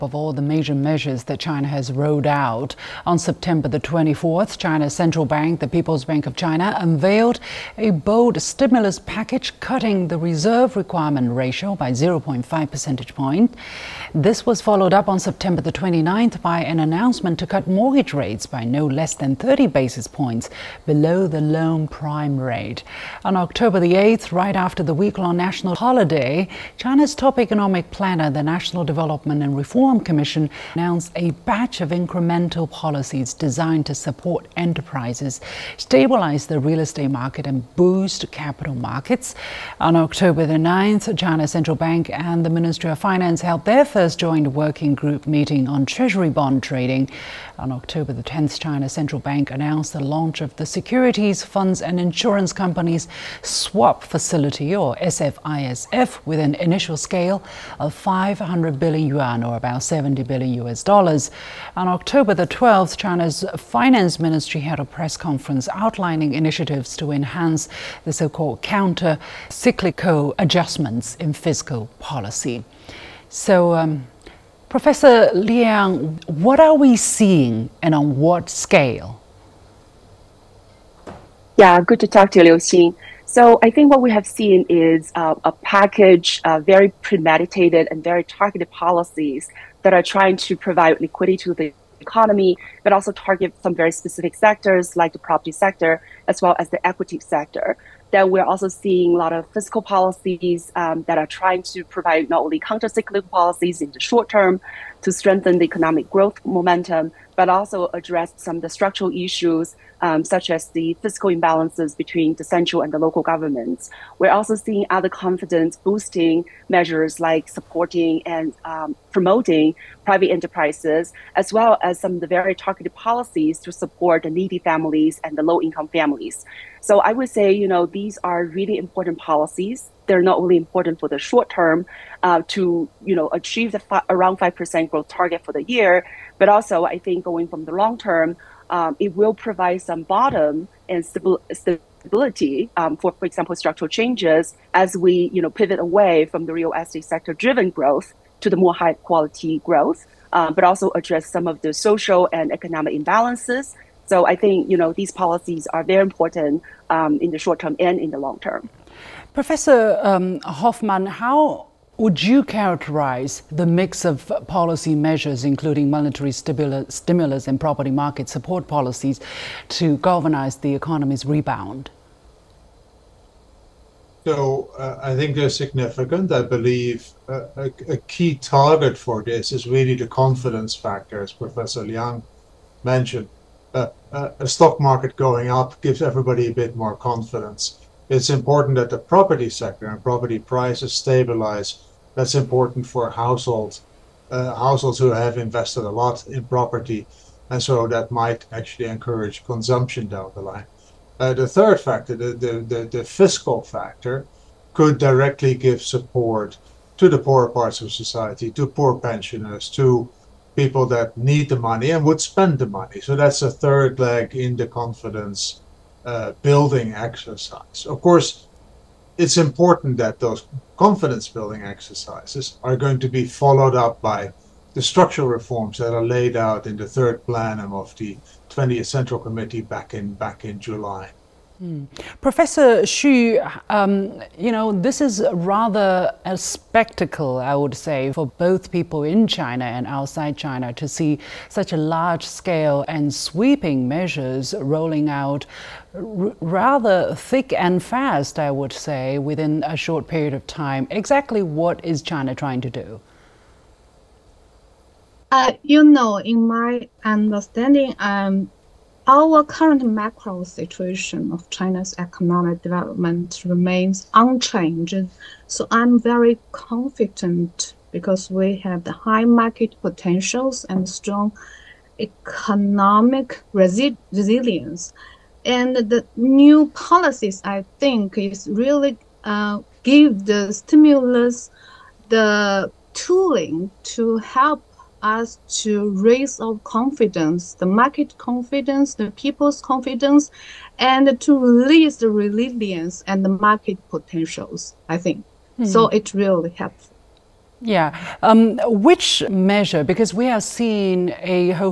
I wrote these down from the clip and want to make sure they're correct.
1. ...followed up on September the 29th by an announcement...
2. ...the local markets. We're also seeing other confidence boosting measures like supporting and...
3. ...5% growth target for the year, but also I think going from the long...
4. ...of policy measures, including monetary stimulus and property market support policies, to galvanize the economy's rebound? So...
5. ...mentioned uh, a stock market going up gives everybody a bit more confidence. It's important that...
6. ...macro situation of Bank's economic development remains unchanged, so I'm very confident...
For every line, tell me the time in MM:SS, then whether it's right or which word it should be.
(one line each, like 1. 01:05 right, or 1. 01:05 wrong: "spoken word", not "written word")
1. 00:14 right
2. 01:52 wrong: "governments", not "markets"
3. 02:14 right
4. 02:44 right
5. 03:02 right
6. 04:19 wrong: "China", not "Bank".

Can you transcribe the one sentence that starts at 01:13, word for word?
So, um, Professor Liang, what are we seeing and on what scale?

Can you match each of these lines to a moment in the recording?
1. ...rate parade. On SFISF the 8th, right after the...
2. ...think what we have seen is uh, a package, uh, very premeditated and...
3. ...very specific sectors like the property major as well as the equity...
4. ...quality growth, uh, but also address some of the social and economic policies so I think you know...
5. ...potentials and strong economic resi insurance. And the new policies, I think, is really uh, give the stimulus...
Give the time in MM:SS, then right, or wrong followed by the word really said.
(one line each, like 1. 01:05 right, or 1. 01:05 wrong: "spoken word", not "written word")
1. 00:22 wrong: "October", not "SFISF"
2. 01:23 right
3. 01:33 wrong: "sector", not "major"
4. 02:28 wrong: "imbalances", not "policies"
5. 04:29 wrong: "resilience", not "insurance".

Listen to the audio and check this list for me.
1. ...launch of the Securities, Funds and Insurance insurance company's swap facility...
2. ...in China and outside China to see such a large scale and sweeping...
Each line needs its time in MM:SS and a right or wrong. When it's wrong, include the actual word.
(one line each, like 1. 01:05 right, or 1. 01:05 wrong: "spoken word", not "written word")
1. 00:50 right
2. 03:59 right.